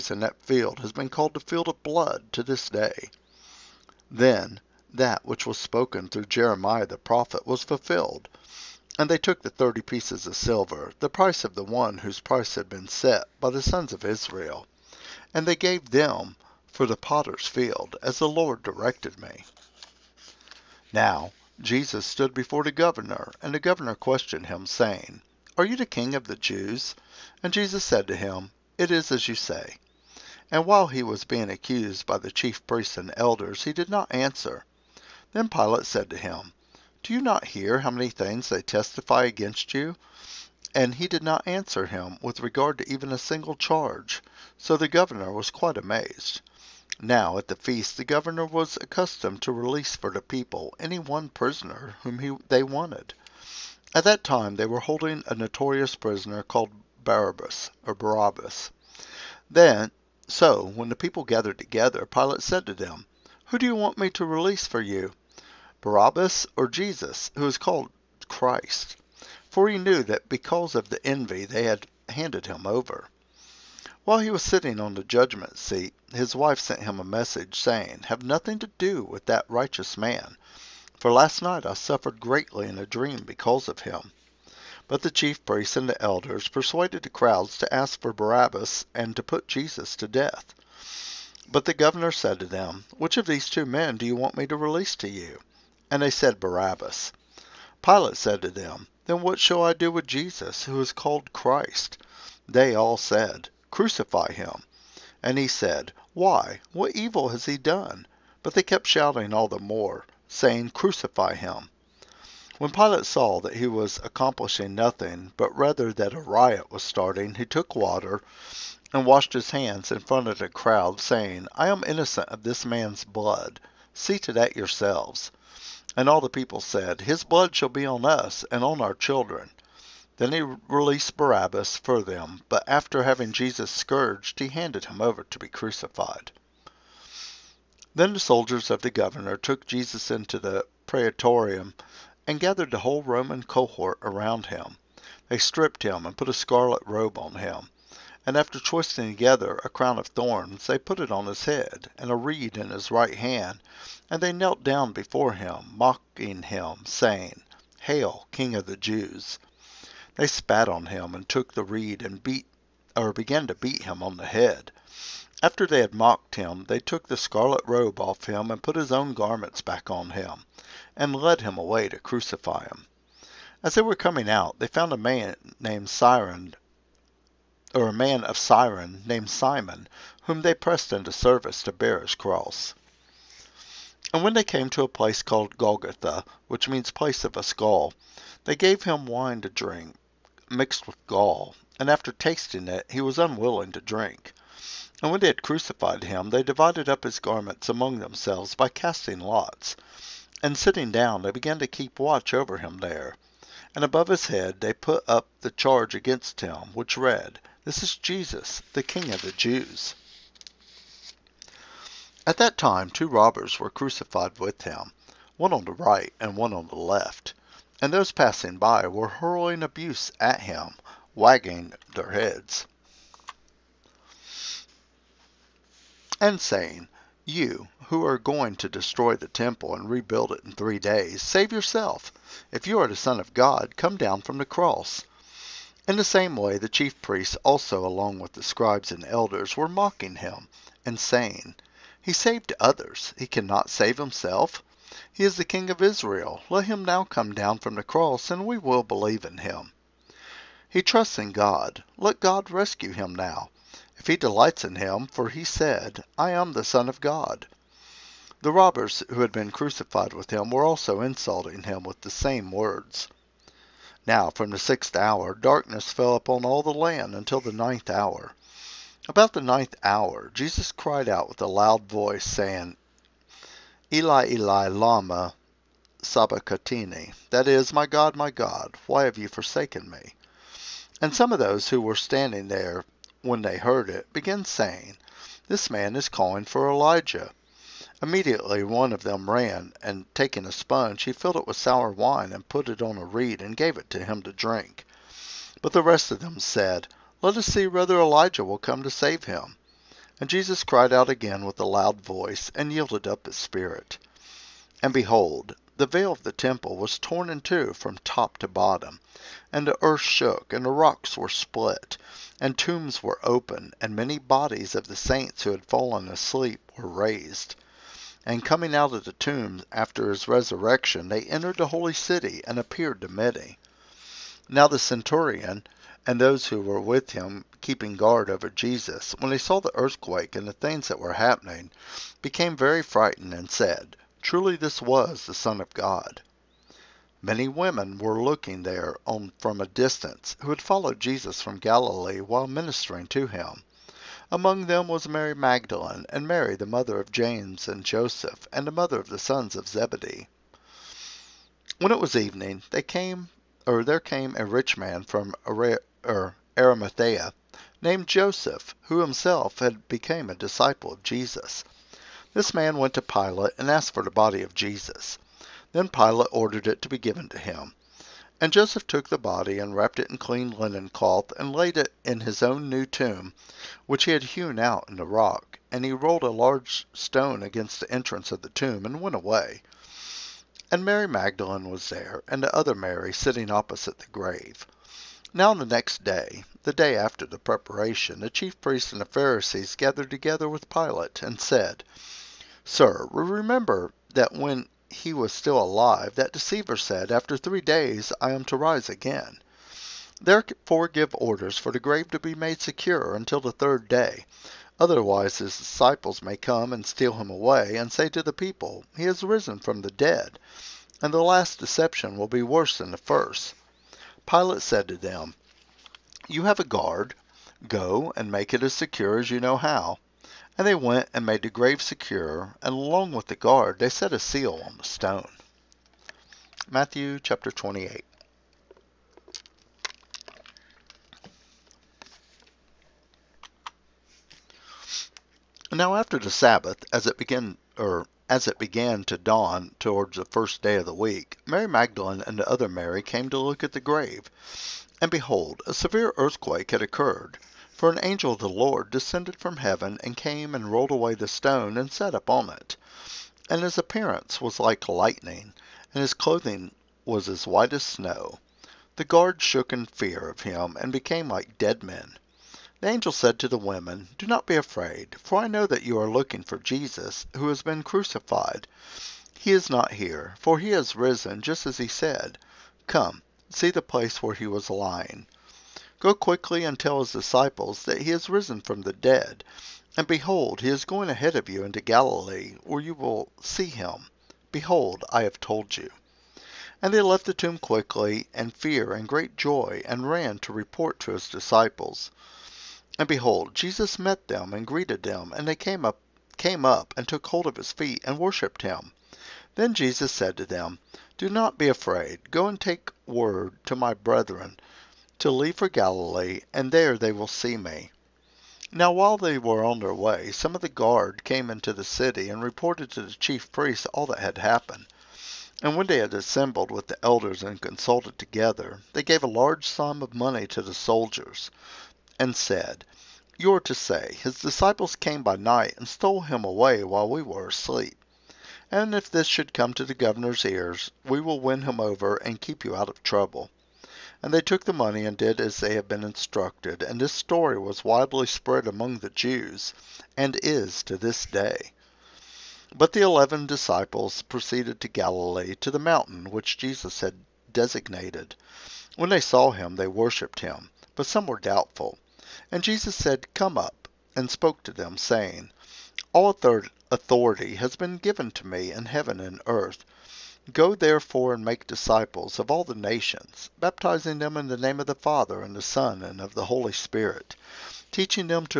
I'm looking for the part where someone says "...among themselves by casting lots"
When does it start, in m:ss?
3:17.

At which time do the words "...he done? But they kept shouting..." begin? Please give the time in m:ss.
1:47.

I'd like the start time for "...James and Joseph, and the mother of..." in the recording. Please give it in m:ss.
5:47.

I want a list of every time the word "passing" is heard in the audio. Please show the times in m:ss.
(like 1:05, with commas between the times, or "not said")
3:38.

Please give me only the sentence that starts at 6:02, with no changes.
This man went to Pilate and asked for the body of Jesus.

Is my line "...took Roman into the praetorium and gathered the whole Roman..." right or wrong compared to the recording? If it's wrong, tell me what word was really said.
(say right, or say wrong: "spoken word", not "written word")
wrong: "Jesus", not "Roman".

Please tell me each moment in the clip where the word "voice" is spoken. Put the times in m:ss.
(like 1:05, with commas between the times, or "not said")
4:31, 5:02.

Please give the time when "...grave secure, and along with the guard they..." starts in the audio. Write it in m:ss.
7:01.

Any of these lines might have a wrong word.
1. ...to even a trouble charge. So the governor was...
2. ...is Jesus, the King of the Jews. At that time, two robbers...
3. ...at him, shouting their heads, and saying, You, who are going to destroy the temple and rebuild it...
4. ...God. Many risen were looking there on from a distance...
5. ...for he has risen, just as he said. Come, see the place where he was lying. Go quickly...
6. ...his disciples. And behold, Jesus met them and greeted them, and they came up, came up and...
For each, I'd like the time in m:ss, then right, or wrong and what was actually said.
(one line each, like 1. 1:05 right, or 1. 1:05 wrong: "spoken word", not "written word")
1. 0:42 wrong: "single", not "trouble"
2. 3:27 right
3. 3:40 wrong: "wagging", not "shouting"
4. 5:35 wrong: "women", not "risen"
5. 7:50 right
6. 8:11 right.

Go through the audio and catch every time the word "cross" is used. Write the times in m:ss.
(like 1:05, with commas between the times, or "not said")
3:02, 3:54, 4:07.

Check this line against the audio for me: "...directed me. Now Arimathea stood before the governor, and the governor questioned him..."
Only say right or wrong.
wrong.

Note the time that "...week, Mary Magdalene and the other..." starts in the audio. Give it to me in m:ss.
7:20.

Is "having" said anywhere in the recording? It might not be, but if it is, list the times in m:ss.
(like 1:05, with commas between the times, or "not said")
2:13.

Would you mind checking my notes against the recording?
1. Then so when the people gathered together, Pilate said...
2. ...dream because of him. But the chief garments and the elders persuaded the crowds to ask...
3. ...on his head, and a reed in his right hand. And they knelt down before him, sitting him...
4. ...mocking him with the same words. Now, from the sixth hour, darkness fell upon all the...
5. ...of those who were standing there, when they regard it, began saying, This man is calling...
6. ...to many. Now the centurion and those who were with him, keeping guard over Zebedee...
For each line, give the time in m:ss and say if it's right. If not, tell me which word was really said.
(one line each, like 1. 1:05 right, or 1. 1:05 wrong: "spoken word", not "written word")
1. 0:59 right
2. 1:22 wrong: "priests", not "garments"
3. 2:31 wrong: "mocking", not "sitting"
4. 4:21 wrong: "insulting", not "mocking"
5. 4:41 wrong: "heard", not "regard"
6. 5:23 wrong: "Jesus", not "Zebedee".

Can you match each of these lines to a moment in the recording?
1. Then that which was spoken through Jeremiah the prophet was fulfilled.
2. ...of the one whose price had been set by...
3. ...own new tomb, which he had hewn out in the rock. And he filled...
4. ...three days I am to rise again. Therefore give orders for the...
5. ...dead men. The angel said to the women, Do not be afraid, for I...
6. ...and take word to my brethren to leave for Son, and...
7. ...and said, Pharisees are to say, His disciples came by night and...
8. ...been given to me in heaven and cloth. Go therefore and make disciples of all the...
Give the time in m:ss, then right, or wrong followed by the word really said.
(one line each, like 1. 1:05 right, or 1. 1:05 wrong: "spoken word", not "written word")
1. 0:04 right
2. 0:11 right
3. 6:12 wrong: "rolled", not "filled"
4. 6:37 right
5. 7:41 right
6. 8:22 wrong: "Galilee", not "Son"
7. 8:42 wrong: "You", not "Pharisees"
8. 9:17 wrong: "earth", not "cloth".